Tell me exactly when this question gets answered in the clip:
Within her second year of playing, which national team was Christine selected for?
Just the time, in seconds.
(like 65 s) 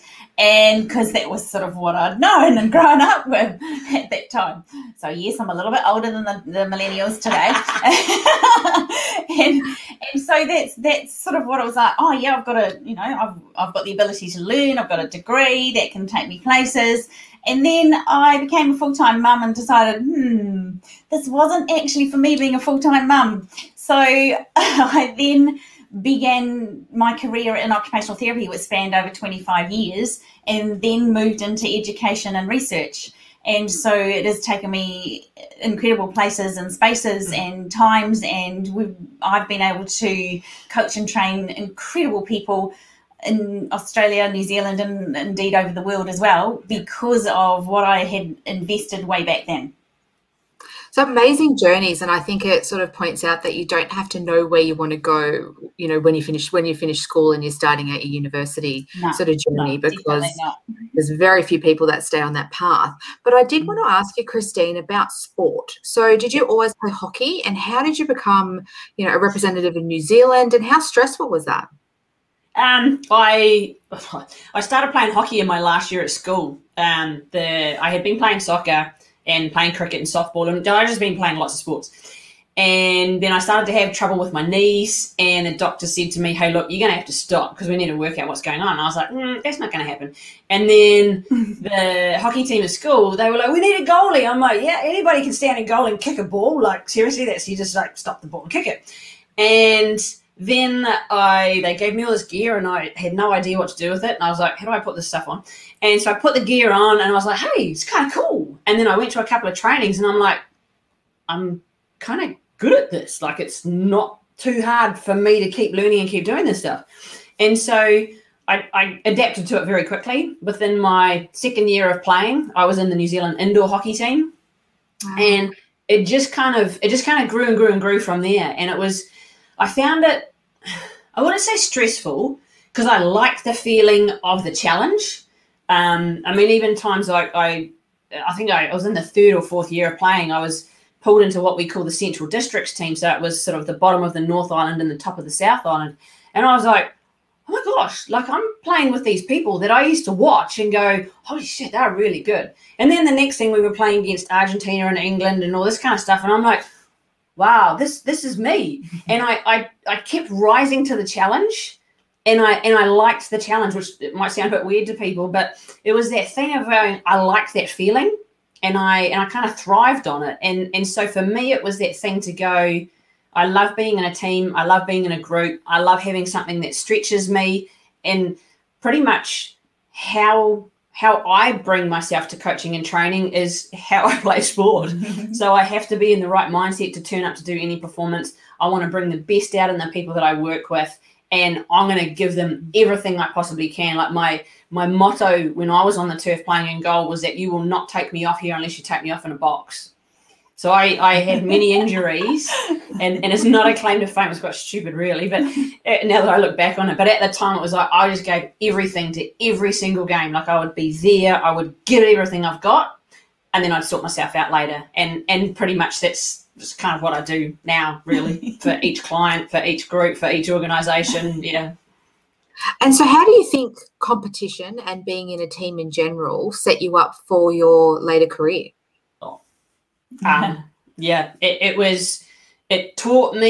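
122 s.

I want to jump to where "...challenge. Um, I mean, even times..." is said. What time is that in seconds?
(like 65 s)
134 s.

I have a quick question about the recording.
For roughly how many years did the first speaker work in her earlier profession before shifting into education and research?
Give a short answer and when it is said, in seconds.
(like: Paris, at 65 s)
25, at 29 s.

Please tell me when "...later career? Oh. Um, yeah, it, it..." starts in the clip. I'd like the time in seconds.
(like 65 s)
228 s.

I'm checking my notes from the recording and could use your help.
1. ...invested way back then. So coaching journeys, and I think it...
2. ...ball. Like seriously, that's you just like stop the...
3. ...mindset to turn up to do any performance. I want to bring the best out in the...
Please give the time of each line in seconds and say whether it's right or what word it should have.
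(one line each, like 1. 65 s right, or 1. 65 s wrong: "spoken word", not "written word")
1. 48 s wrong: "amazing", not "coaching"
2. 96 s right
3. 186 s right.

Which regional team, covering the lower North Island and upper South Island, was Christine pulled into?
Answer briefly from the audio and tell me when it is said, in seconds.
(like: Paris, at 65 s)
Central Districts, at 141 s.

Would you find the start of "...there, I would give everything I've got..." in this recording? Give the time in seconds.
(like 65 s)
210 s.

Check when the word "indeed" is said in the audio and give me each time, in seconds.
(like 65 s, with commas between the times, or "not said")
45 s.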